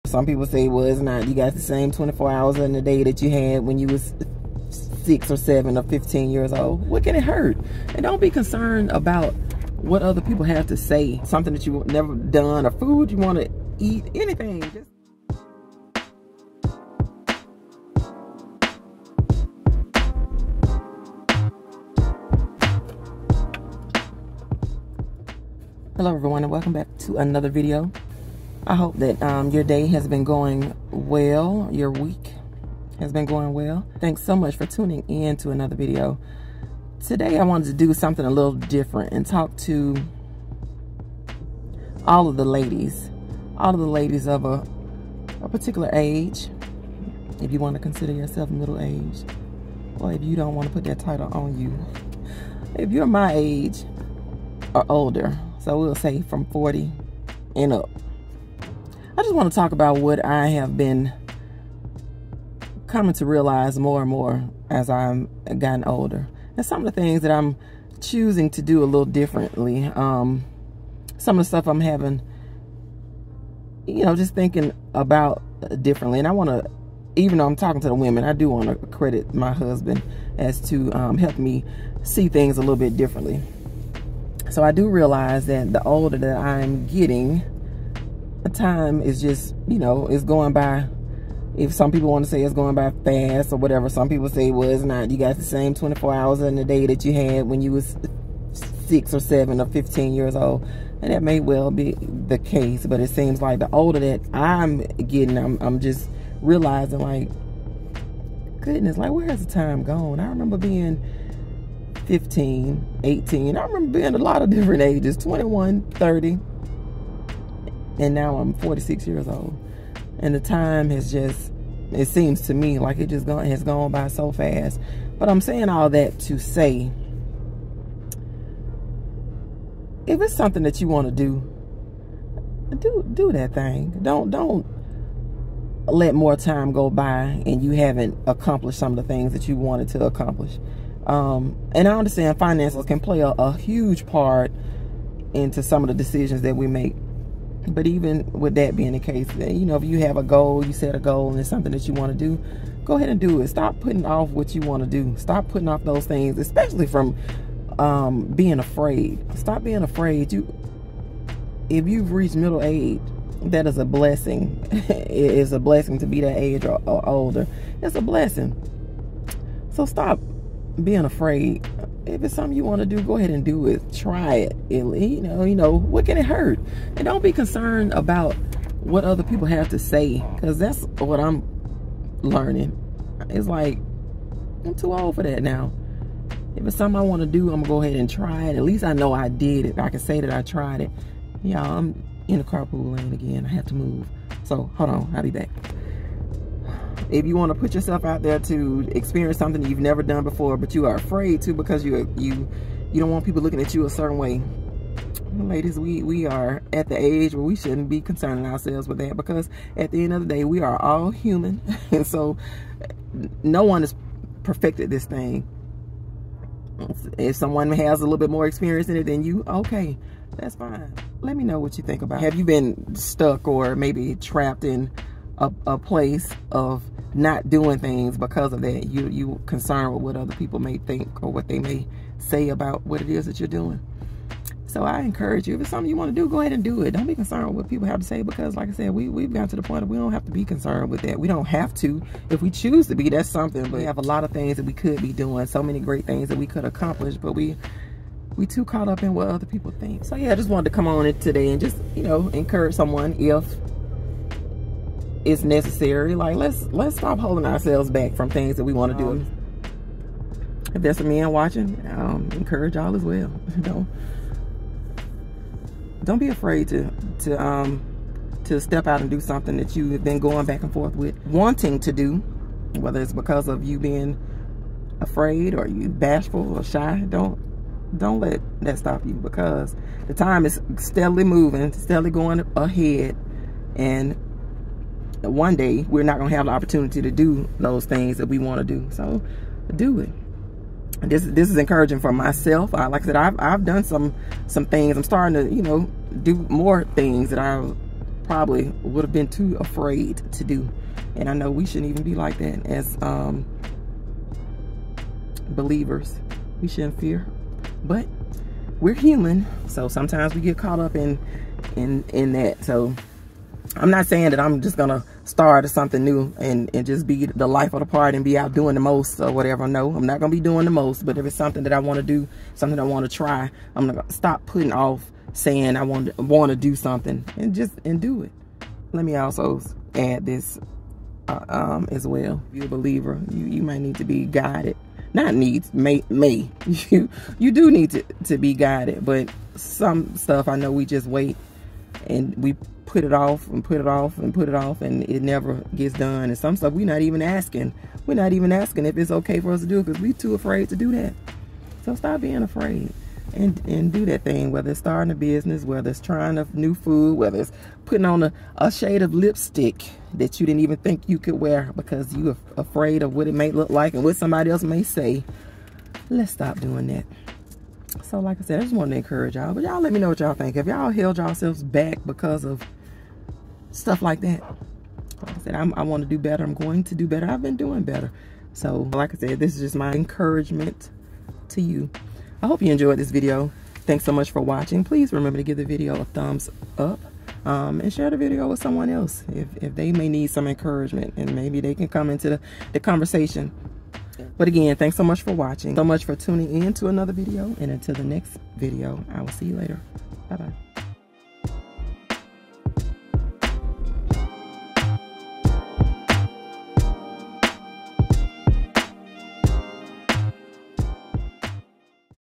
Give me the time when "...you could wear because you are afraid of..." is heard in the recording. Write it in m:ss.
6:01.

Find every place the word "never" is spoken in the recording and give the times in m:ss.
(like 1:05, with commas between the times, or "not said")
0:11, 3:19, 5:45.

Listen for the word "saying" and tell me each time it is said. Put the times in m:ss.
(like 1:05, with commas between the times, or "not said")
2:05, 5:14, 5:25.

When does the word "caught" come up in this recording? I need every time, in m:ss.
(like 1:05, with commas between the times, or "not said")
4:08, 5:10.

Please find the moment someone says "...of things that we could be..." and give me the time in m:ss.
4:04.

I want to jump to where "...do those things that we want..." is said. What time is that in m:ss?
4:47.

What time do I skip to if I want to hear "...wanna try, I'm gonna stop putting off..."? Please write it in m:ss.
5:22.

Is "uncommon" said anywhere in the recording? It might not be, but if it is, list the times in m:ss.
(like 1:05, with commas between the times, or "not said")
not said.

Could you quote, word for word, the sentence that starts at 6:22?
I hope you enjoyed this video.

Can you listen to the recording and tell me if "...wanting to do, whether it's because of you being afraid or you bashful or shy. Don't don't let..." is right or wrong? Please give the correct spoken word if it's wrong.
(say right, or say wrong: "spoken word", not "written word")
right.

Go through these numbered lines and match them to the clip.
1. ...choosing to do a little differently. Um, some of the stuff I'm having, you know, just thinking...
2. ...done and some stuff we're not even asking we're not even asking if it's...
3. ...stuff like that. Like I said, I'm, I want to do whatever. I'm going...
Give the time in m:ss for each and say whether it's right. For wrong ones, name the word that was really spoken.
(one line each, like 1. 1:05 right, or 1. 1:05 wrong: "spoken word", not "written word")
1. 1:07 right
2. 5:45 right
3. 6:13 wrong: "better", not "whatever".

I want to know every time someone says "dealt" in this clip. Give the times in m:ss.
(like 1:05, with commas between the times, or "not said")
not said.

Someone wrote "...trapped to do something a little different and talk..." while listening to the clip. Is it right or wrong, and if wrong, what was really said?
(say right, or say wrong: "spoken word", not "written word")
wrong: "wanted", not "trapped".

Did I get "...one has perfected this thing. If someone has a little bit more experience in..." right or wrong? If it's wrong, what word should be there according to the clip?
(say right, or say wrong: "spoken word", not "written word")
right.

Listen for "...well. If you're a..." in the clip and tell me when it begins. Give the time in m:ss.
5:32.